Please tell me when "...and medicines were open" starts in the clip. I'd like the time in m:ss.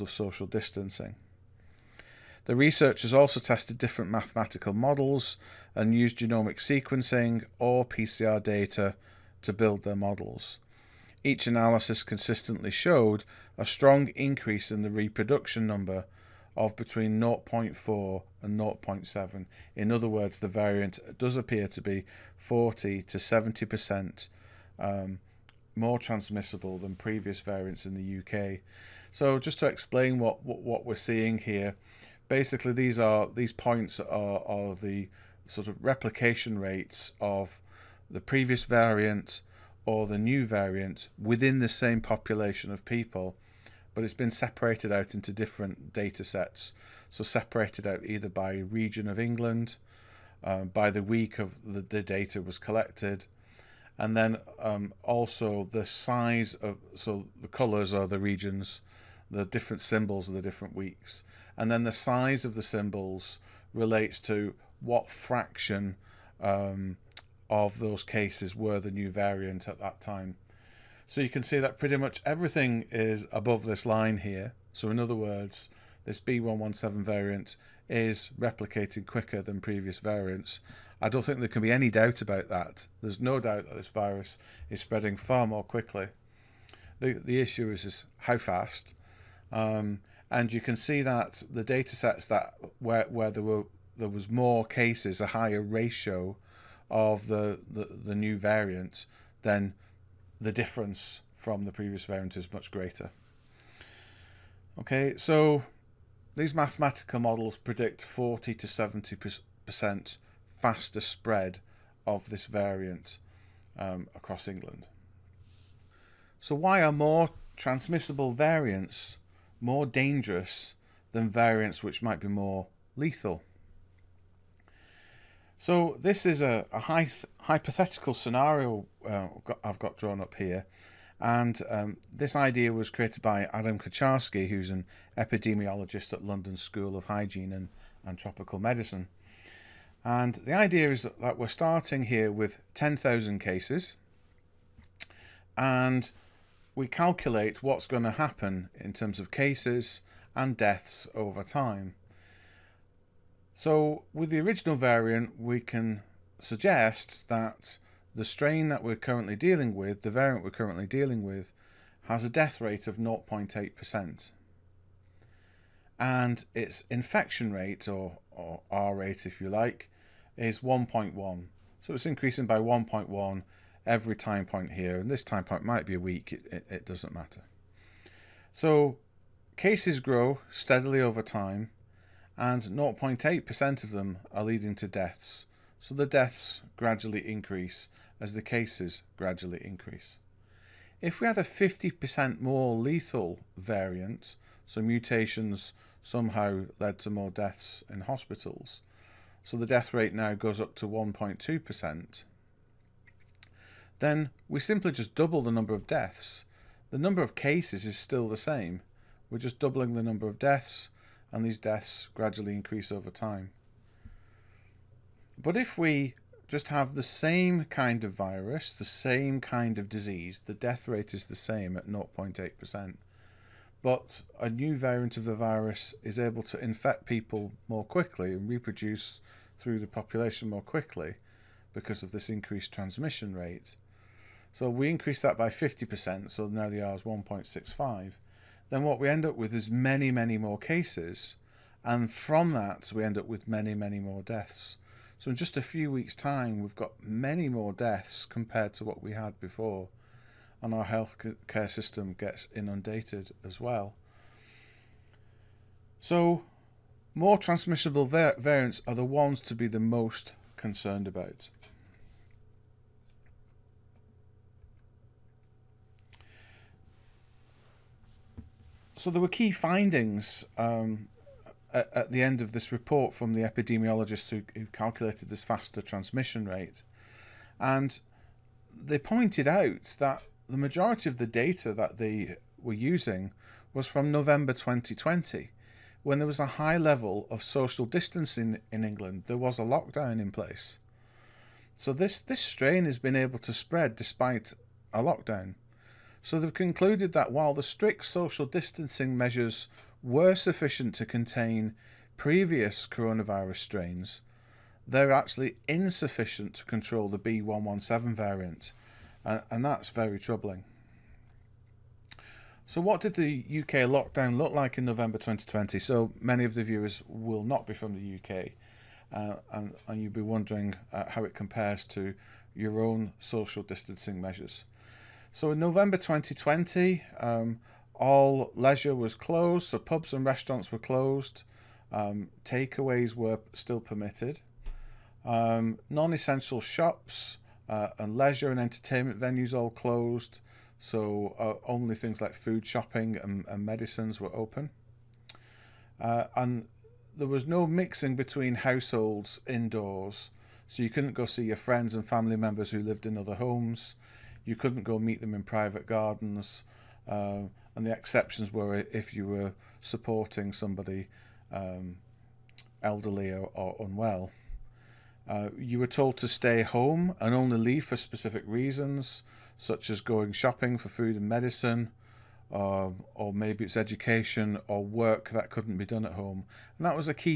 5:43.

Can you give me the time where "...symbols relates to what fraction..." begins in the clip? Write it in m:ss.
1:02.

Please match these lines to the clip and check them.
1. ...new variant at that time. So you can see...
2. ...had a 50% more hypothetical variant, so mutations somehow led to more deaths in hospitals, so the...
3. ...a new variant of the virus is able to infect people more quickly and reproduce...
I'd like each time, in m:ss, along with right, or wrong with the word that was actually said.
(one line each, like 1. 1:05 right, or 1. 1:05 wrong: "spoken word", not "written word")
1. 1:08 right
2. 3:11 wrong: "lethal", not "hypothetical"
3. 3:44 right.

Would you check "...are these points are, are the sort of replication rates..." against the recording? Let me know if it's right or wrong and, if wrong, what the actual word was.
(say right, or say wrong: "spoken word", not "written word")
right.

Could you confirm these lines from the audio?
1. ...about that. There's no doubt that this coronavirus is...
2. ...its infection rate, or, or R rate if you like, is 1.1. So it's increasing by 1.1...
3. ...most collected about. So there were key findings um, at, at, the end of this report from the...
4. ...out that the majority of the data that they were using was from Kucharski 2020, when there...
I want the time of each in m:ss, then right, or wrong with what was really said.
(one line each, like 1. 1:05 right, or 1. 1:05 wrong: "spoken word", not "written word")
1. 1:22 wrong: "virus", not "coronavirus"
2. 2:46 right
3. 4:19 wrong: "concerned", not "collected"
4. 4:39 wrong: "November", not "Kucharski".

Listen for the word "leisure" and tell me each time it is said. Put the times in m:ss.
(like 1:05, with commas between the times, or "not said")
5:28, 5:38.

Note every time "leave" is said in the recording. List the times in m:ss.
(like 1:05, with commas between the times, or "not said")
6:07.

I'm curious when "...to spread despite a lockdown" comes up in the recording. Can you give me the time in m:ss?
4:53.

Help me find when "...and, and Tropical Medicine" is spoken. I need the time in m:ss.
2:17.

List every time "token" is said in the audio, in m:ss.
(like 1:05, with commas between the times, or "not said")
not said.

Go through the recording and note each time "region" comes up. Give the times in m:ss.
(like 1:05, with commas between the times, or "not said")
0:48, 0:58.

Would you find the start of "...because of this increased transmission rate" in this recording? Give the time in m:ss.
3:51.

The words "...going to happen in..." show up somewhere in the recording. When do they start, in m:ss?
2:27.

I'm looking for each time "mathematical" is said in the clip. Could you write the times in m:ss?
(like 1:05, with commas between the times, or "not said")
0:04, 1:46.